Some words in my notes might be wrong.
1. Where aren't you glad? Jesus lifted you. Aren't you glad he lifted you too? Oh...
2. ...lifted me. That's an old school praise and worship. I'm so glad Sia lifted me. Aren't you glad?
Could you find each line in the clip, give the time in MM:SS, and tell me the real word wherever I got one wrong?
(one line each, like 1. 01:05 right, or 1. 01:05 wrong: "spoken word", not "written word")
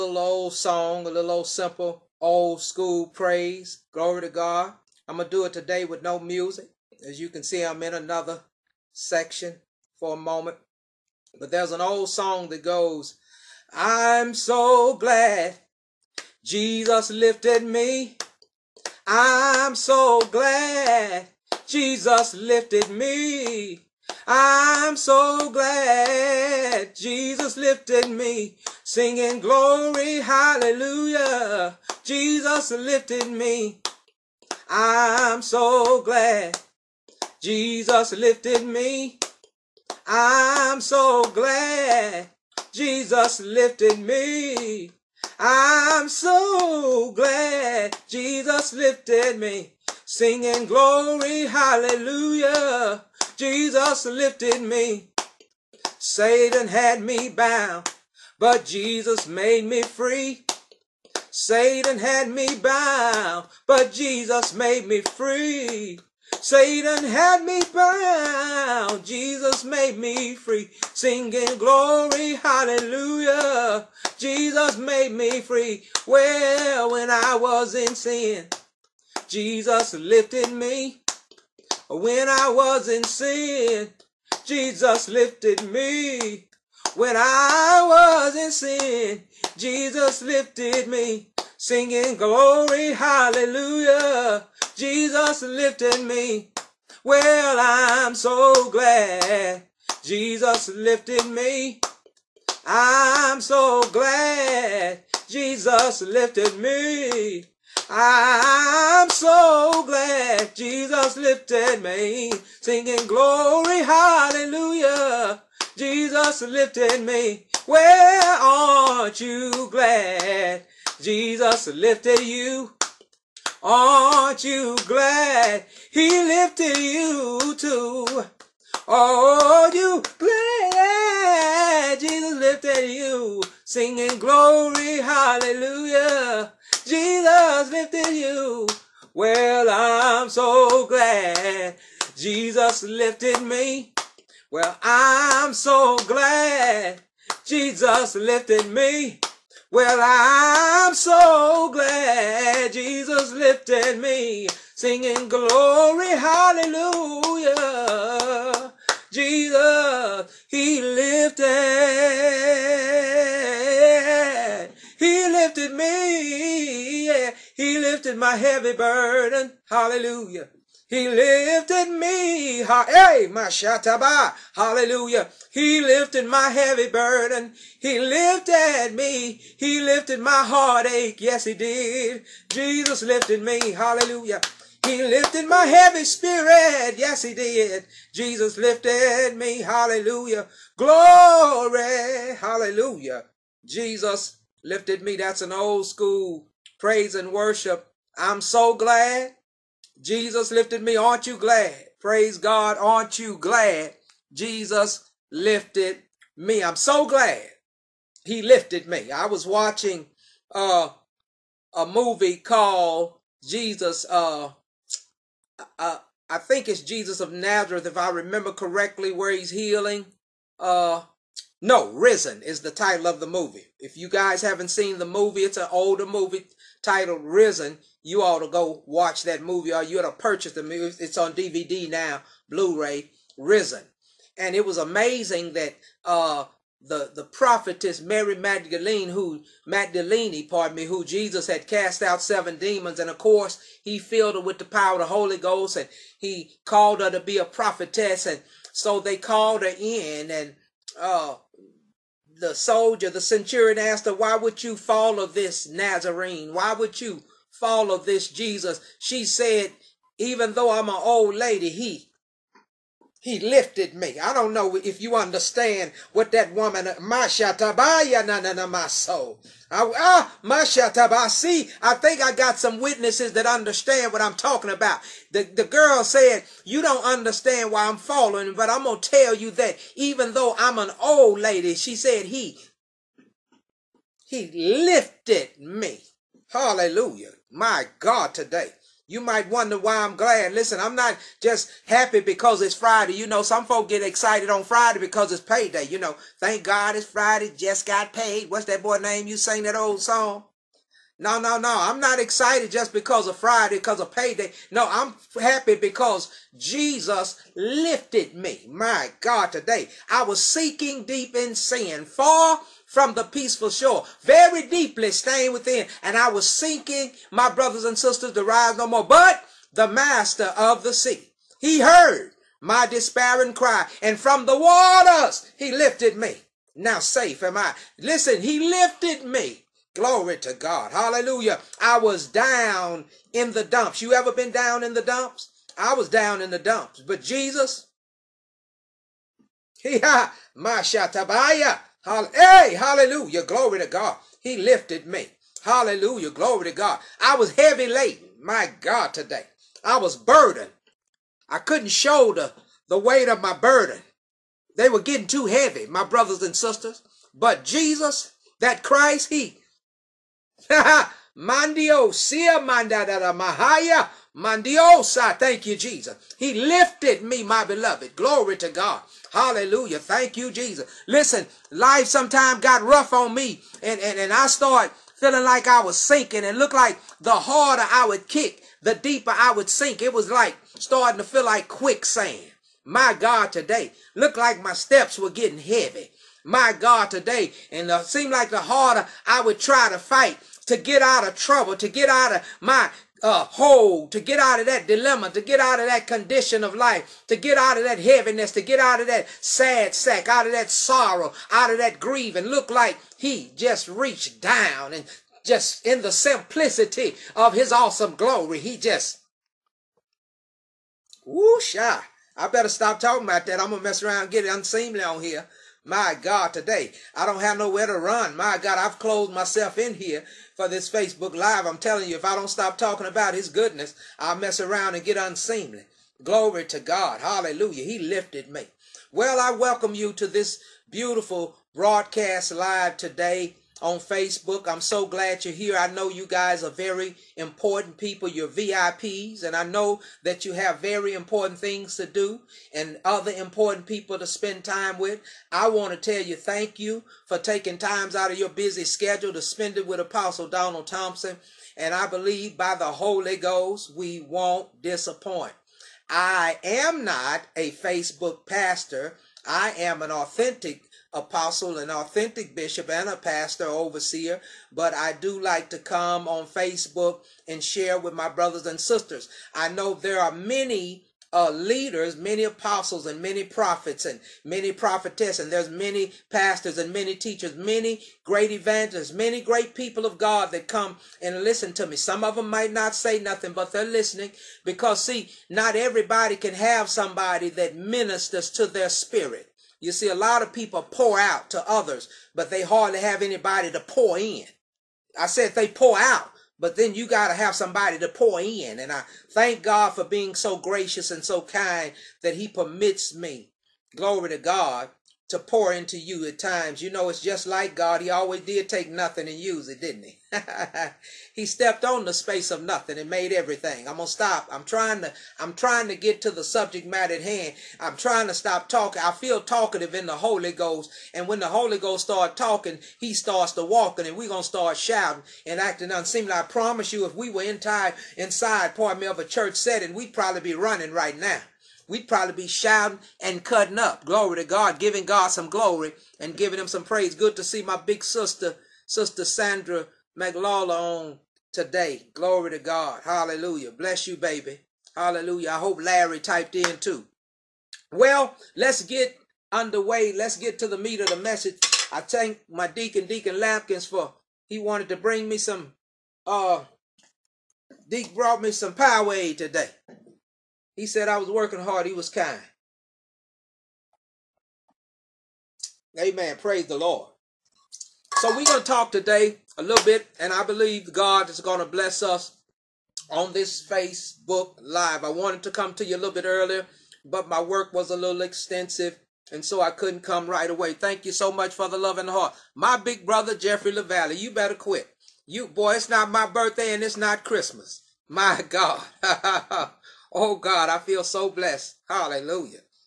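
1. 01:57 right
2. 03:14 wrong: "Jesus", not "Sia".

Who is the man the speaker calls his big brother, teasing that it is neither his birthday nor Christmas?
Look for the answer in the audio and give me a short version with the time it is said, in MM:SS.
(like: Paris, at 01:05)
Jeffrey LaValle, at 09:43.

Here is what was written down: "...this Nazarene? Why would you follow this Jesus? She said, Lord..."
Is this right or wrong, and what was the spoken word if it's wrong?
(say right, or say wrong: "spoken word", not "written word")
wrong: "Even", not "Lord".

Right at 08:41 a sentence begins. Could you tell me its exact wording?
And when the Holy Ghost starts talking, he starts to walking and we're gonna start shouting and acting unseemly.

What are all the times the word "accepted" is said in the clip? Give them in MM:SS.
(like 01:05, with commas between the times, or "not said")
not said.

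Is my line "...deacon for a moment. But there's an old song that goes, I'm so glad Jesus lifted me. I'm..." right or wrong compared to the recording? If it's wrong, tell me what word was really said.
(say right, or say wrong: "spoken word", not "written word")
wrong: "section", not "deacon".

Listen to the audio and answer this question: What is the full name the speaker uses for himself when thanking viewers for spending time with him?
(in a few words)
Apostle Donald Thompson.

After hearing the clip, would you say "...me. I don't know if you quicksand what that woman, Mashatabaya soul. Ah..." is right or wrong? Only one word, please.
wrong.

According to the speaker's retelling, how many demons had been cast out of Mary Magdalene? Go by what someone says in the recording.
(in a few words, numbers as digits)
7.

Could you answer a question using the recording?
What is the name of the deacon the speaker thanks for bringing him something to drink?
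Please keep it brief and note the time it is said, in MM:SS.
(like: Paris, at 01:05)
Deacon Lampkins, at 09:13.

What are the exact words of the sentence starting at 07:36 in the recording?
I am not a Facebook pastor.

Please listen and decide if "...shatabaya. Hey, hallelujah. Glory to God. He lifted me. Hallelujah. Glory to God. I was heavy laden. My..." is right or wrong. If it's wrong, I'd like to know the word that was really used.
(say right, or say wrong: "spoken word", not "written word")
right.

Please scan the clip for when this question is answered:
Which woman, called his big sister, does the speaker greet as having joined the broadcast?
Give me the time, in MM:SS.
08:58.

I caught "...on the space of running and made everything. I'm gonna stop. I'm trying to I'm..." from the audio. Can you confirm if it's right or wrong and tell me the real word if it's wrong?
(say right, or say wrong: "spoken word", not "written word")
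wrong: "nothing", not "running".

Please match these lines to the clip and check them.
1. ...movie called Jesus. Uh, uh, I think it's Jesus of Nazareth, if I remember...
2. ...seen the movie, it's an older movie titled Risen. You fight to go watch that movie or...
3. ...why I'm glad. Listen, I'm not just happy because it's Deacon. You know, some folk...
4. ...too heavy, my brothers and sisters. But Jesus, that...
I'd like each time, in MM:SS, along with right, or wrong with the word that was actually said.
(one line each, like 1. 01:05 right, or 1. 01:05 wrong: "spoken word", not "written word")
1. 03:31 right
2. 03:44 wrong: "ought", not "fight"
3. 04:49 wrong: "Friday", not "Deacon"
4. 05:55 right.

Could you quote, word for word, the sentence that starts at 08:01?
Some of them might not say nothing, but they're listening because, see, not everybody can have somebody that ministers to their spirit.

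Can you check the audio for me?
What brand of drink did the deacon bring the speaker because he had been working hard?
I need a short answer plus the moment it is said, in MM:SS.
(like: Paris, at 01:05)
Powerade, at 09:18.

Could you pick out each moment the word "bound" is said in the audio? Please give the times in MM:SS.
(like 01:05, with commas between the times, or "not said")
00:57, 01:02, 01:07.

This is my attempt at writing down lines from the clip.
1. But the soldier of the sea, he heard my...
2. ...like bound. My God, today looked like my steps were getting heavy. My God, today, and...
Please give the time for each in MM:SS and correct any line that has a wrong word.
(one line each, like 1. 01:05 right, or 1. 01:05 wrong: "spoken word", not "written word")
1. 05:19 wrong: "master", not "soldier"
2. 06:21 wrong: "quicksand", not "bound".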